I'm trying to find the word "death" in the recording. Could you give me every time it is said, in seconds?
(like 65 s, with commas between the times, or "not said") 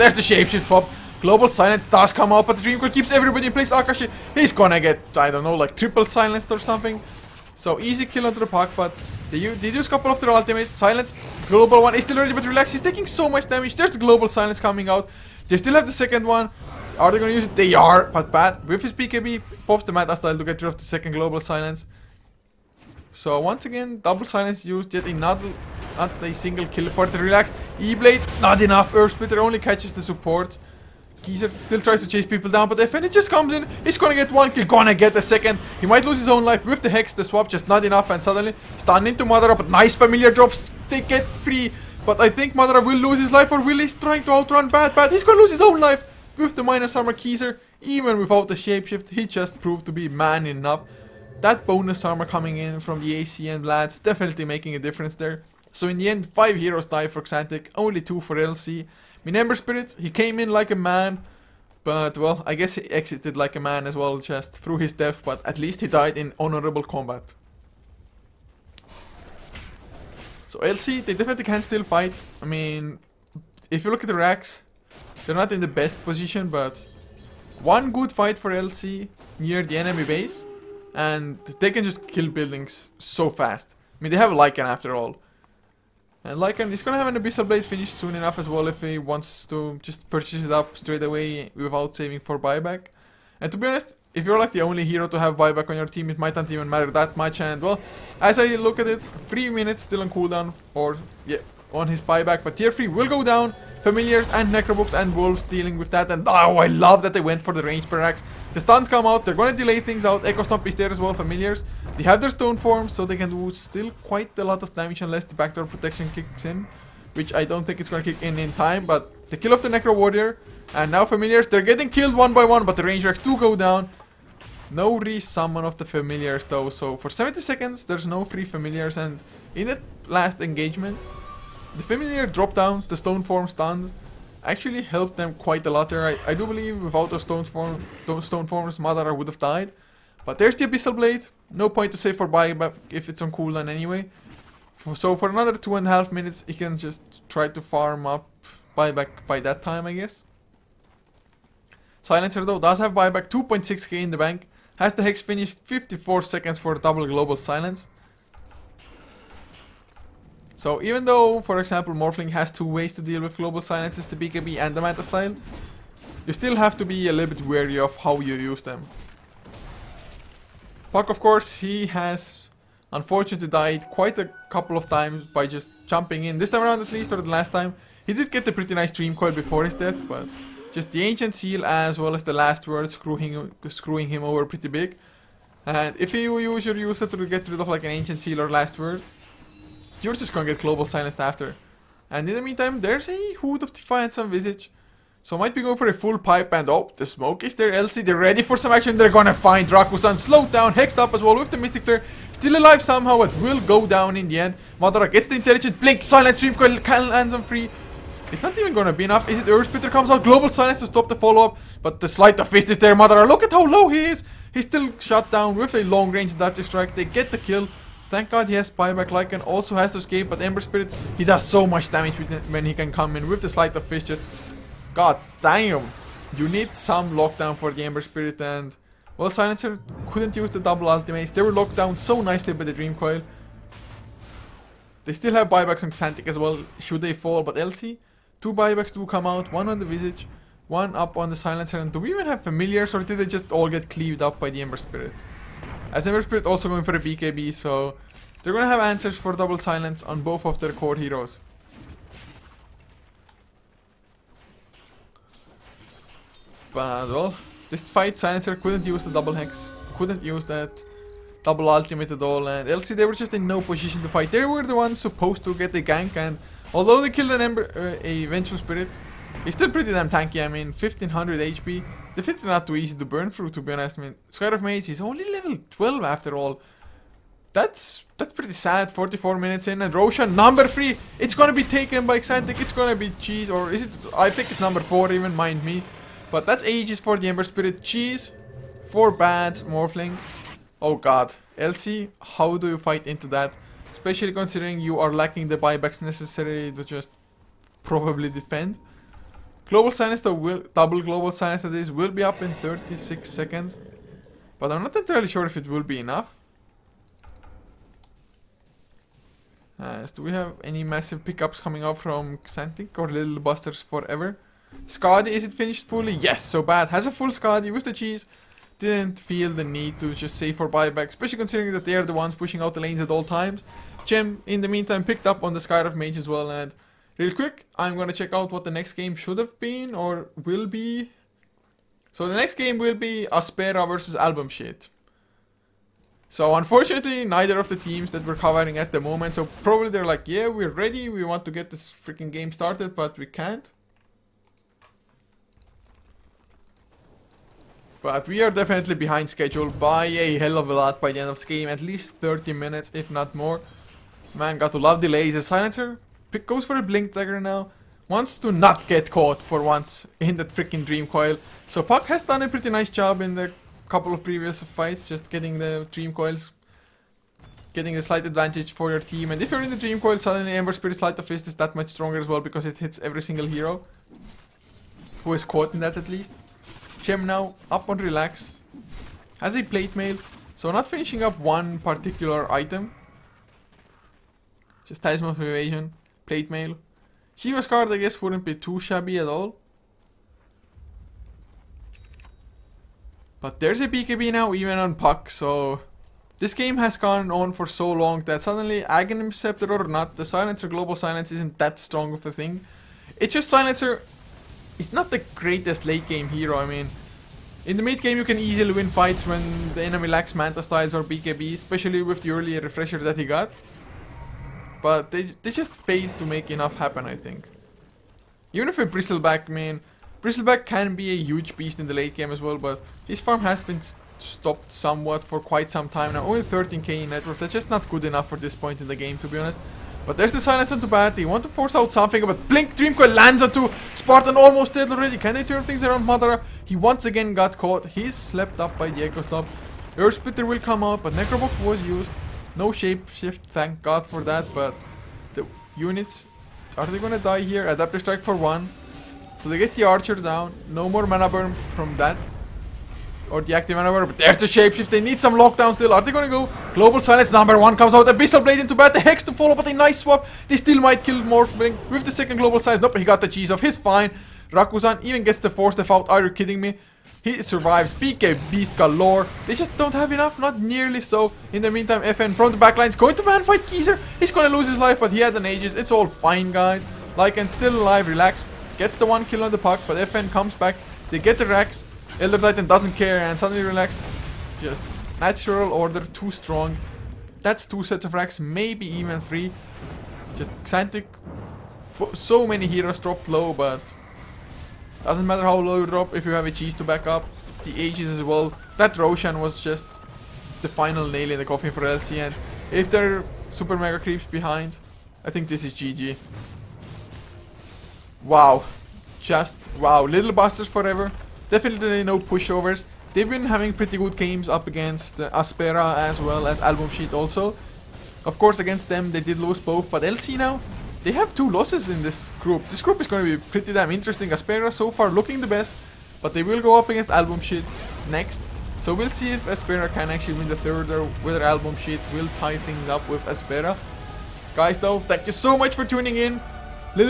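64 s, 179 s.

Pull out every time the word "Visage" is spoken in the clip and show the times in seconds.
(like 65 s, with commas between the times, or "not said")
194 s, 239 s.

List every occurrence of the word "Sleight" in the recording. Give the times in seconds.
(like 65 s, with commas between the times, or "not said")
212 s, 223 s, 370 s.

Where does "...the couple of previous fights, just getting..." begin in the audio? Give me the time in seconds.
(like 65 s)
363 s.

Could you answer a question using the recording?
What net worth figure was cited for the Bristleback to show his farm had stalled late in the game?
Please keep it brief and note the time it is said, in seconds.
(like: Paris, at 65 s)
13k, at 426 s.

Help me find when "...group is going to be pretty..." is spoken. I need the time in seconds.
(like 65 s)
522 s.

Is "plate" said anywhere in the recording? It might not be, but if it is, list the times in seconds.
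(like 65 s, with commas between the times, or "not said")
379 s, 386 s.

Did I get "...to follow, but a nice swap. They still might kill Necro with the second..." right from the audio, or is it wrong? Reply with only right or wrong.
wrong.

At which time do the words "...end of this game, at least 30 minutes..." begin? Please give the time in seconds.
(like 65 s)
351 s.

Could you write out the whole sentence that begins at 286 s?
But that's Aegis for the Ember Spirit, cheese, 4 bats, Morphling.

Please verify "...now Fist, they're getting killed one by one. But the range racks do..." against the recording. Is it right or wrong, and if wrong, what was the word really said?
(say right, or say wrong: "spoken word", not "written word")
wrong: "Familiars", not "Fist".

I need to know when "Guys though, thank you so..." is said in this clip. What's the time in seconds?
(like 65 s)
534 s.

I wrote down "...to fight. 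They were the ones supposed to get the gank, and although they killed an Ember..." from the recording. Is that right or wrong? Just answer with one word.
right.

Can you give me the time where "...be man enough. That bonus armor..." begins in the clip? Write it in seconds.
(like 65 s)
49 s.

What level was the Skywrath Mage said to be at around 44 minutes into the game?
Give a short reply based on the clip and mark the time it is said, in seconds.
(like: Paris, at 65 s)
12, at 275 s.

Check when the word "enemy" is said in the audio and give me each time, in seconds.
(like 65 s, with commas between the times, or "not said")
79 s, 409 s.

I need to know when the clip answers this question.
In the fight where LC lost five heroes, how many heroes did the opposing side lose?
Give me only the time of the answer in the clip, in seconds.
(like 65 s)
57 s.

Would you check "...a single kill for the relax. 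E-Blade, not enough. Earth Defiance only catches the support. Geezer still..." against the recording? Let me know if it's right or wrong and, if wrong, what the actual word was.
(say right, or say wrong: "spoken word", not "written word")
wrong: "Splitter", not "Defiance".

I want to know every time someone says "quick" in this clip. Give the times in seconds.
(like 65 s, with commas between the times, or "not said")
327 s.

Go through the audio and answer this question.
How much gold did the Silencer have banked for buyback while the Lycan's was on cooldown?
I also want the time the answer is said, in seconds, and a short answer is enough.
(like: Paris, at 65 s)
2.6k, at 153 s.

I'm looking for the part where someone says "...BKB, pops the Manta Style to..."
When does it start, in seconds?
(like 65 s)
18 s.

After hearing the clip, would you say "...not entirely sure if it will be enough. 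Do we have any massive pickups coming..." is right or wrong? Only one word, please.
right.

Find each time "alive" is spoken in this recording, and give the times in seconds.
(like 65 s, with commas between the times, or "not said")
202 s, 477 s.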